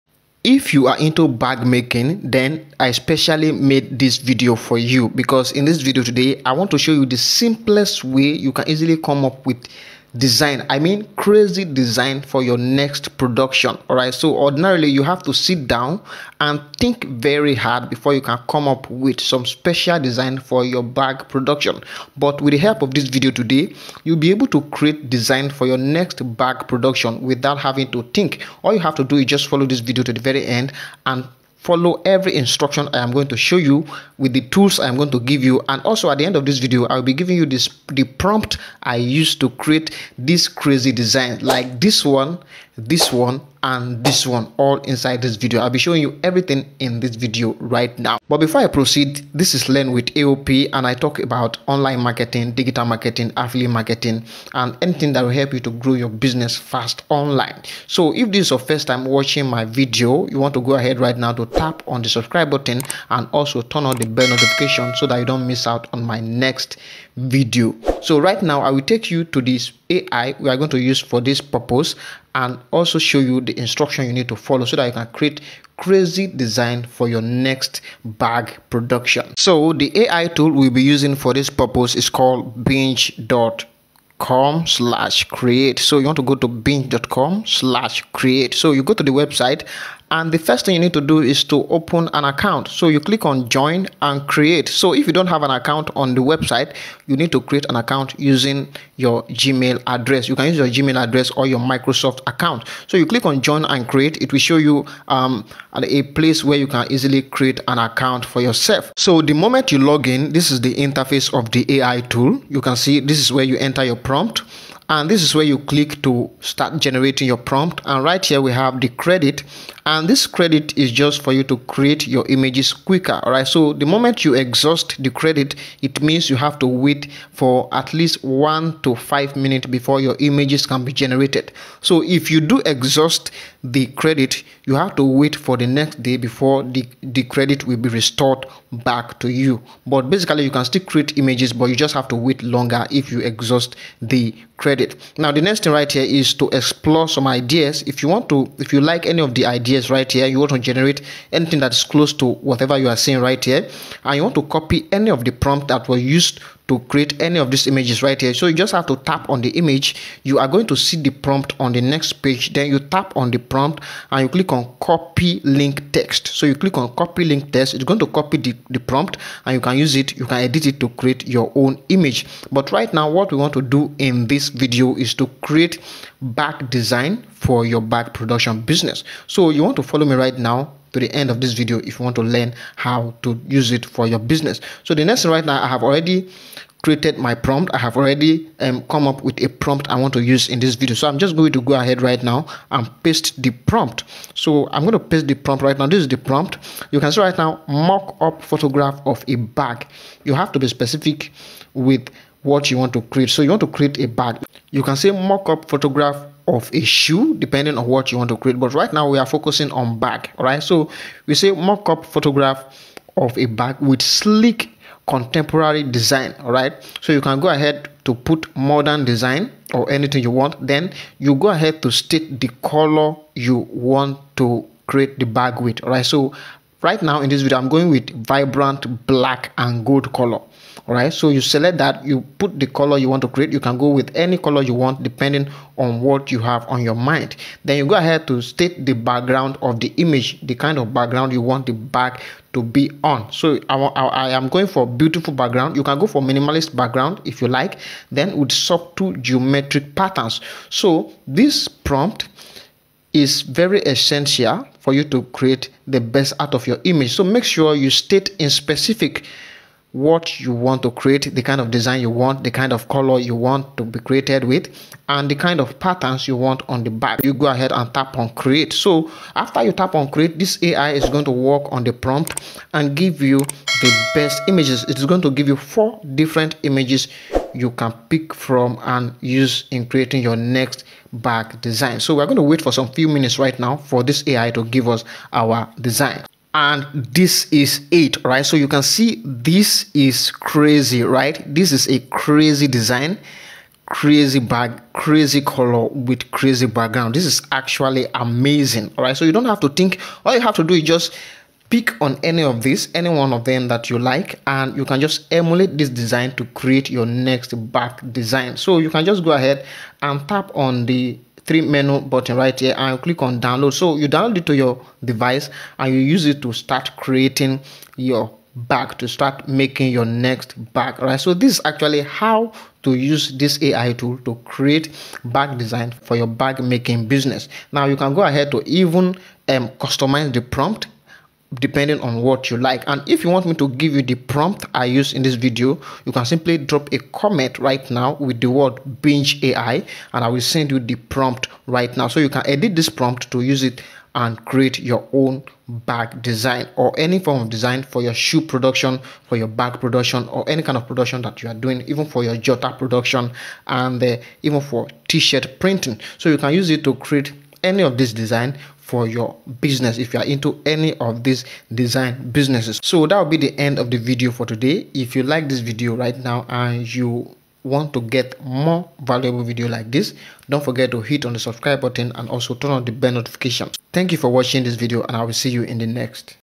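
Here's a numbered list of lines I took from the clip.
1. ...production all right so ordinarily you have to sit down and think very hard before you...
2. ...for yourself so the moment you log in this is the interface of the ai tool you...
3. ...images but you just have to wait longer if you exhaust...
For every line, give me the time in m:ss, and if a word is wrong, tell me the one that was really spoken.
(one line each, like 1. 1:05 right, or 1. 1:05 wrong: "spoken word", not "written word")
1. 0:13 right
2. 1:48 right
3. 2:21 right.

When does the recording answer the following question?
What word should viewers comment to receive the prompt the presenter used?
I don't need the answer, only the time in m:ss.
5:39.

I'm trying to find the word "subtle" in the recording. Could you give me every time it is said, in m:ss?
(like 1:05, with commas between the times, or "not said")
4:08.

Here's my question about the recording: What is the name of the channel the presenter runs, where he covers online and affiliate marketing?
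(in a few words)
Learn with AOP.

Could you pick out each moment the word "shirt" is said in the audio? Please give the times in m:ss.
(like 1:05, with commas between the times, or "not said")
5:55.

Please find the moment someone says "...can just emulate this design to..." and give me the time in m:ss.
5:04.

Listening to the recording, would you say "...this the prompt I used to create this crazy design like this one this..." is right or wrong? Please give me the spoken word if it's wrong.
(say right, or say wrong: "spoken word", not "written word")
right.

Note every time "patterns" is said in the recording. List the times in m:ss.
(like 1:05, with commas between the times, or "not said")
4:09, 4:25.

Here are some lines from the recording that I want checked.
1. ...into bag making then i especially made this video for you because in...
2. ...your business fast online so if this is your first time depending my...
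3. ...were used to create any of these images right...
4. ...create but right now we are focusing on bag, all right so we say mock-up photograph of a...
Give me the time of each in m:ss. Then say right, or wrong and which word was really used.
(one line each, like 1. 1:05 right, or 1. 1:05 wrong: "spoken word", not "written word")
1. 0:00 right
2. 0:55 wrong: "watching", not "depending"
3. 2:35 right
4. 3:28 right.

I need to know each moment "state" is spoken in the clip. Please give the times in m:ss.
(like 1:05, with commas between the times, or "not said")
3:41, 3:58, 4:17.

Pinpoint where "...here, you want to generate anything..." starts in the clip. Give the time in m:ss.
2:30.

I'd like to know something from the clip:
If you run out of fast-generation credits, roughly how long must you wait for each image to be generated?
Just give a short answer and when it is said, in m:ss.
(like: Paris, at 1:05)
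1 to 5 minutes, at 2:08.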